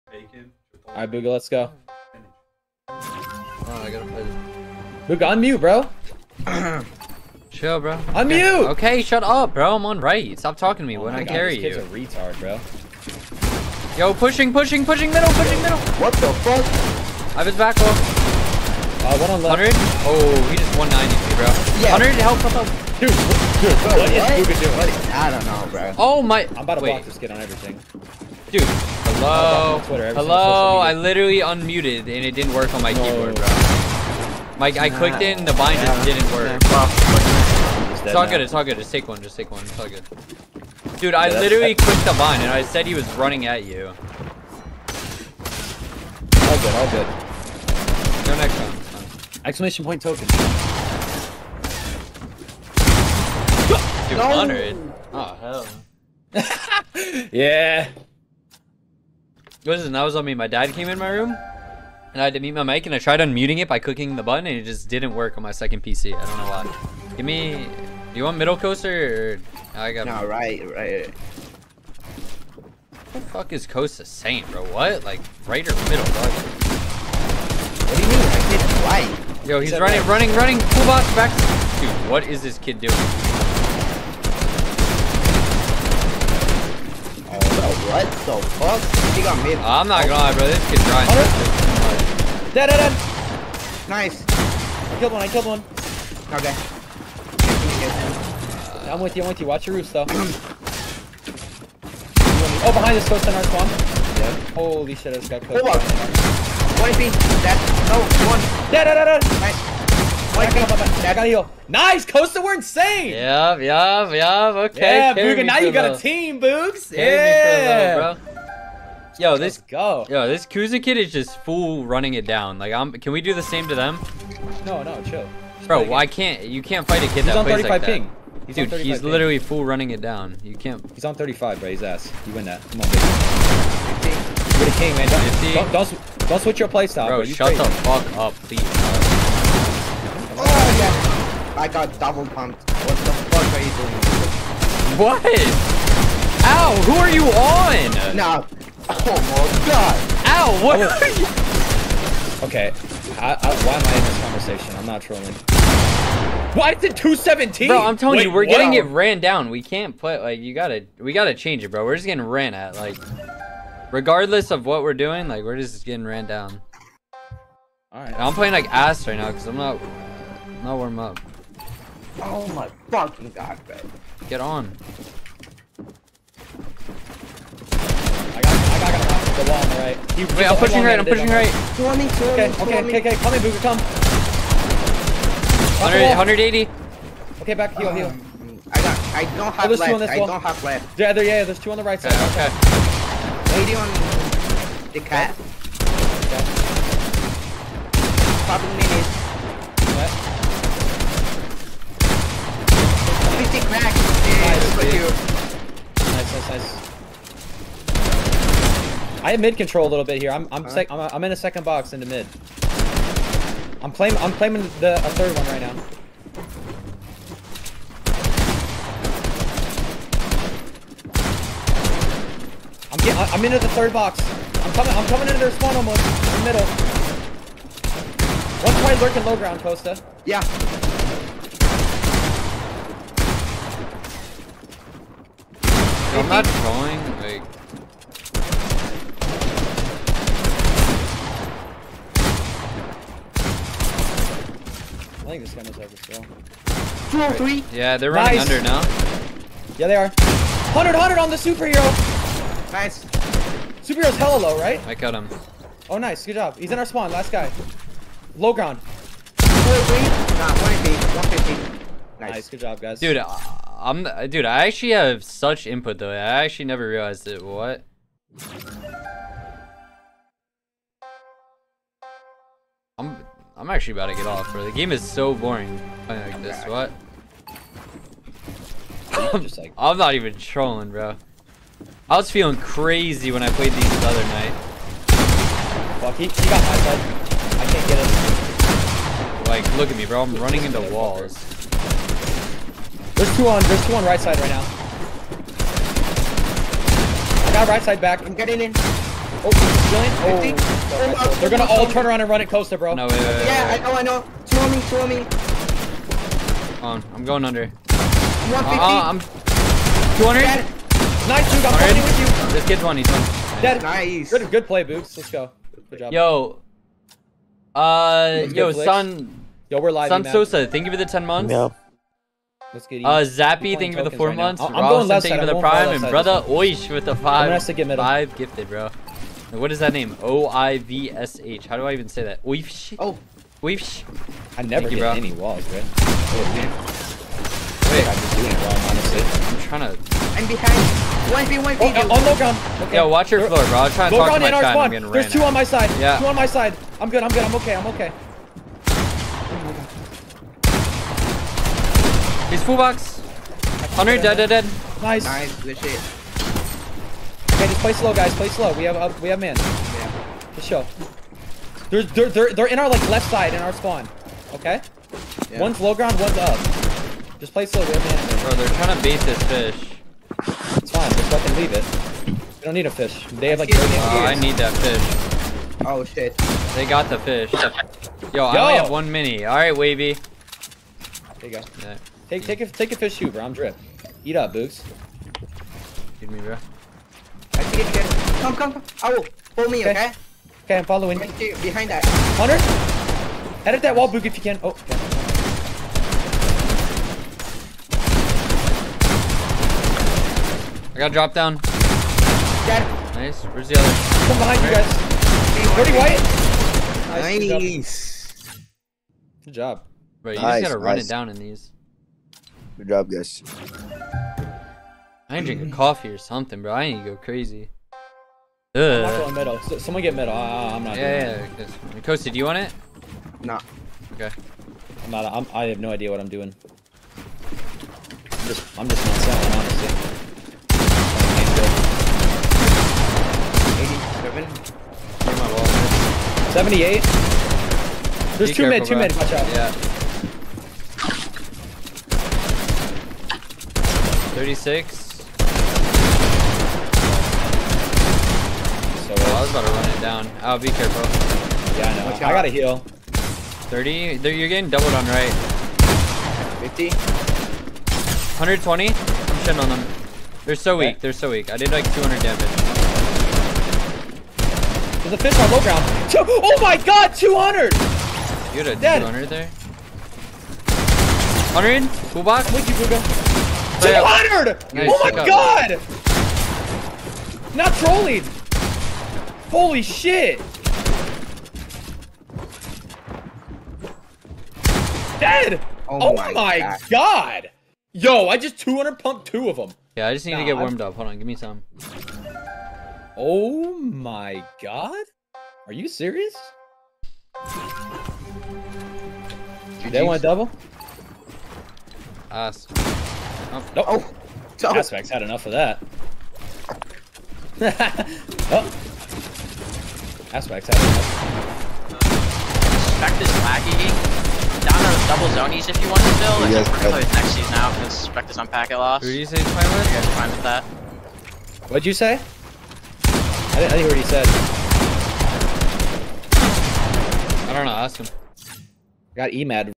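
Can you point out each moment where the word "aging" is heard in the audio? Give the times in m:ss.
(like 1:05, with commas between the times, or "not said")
not said.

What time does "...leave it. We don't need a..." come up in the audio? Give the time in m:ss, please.
6:11.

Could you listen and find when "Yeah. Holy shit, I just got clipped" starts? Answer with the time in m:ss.
1:43.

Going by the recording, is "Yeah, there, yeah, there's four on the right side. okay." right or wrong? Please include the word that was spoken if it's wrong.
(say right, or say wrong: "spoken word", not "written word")
wrong: "two", not "four".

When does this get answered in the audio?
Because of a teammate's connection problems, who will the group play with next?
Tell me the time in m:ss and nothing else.
8:36.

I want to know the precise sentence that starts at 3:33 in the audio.
I'm claiming I'm claiming the a third one right now.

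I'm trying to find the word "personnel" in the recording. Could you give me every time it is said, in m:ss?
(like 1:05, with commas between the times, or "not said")
not said.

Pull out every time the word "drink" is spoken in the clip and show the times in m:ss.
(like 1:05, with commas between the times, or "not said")
6:55.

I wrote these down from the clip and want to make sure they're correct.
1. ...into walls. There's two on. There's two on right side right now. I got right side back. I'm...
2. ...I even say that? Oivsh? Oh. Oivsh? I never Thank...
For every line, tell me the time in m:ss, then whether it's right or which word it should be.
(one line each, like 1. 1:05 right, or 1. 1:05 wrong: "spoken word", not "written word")
1. 4:50 right
2. 5:31 right.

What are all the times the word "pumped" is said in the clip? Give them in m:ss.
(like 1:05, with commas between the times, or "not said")
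2:22, 8:08.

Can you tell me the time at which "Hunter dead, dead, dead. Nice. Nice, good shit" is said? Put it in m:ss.
5:53.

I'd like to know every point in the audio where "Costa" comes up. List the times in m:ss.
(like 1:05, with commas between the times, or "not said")
1:13, 1:52, 3:49.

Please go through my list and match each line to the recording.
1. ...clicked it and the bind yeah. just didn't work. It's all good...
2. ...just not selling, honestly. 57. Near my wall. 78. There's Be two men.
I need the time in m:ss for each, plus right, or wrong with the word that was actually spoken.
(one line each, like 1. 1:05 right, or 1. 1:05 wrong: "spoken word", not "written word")
1. 0:34 right
2. 7:08 wrong: "87", not "57".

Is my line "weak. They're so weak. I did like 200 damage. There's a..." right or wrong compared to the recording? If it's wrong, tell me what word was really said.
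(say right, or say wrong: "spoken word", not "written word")
right.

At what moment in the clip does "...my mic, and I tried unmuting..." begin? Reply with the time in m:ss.
1:02.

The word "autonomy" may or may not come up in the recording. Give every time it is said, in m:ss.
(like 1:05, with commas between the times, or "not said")
not said.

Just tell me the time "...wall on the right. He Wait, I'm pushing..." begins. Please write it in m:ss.
2:59.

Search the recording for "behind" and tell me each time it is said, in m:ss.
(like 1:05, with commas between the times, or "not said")
1:42, 5:40, 6:31, 6:44.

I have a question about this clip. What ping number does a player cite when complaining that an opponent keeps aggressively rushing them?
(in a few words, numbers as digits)
35.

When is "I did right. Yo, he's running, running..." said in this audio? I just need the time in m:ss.
1:18.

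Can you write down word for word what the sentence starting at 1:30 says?
This kid's trying Oh, dead, dead, dead.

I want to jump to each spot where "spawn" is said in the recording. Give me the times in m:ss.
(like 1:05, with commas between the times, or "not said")
1:43, 3:45, 4:16, 5:45, 6:03.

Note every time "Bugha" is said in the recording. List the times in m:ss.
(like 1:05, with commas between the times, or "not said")
1:55, 7:52.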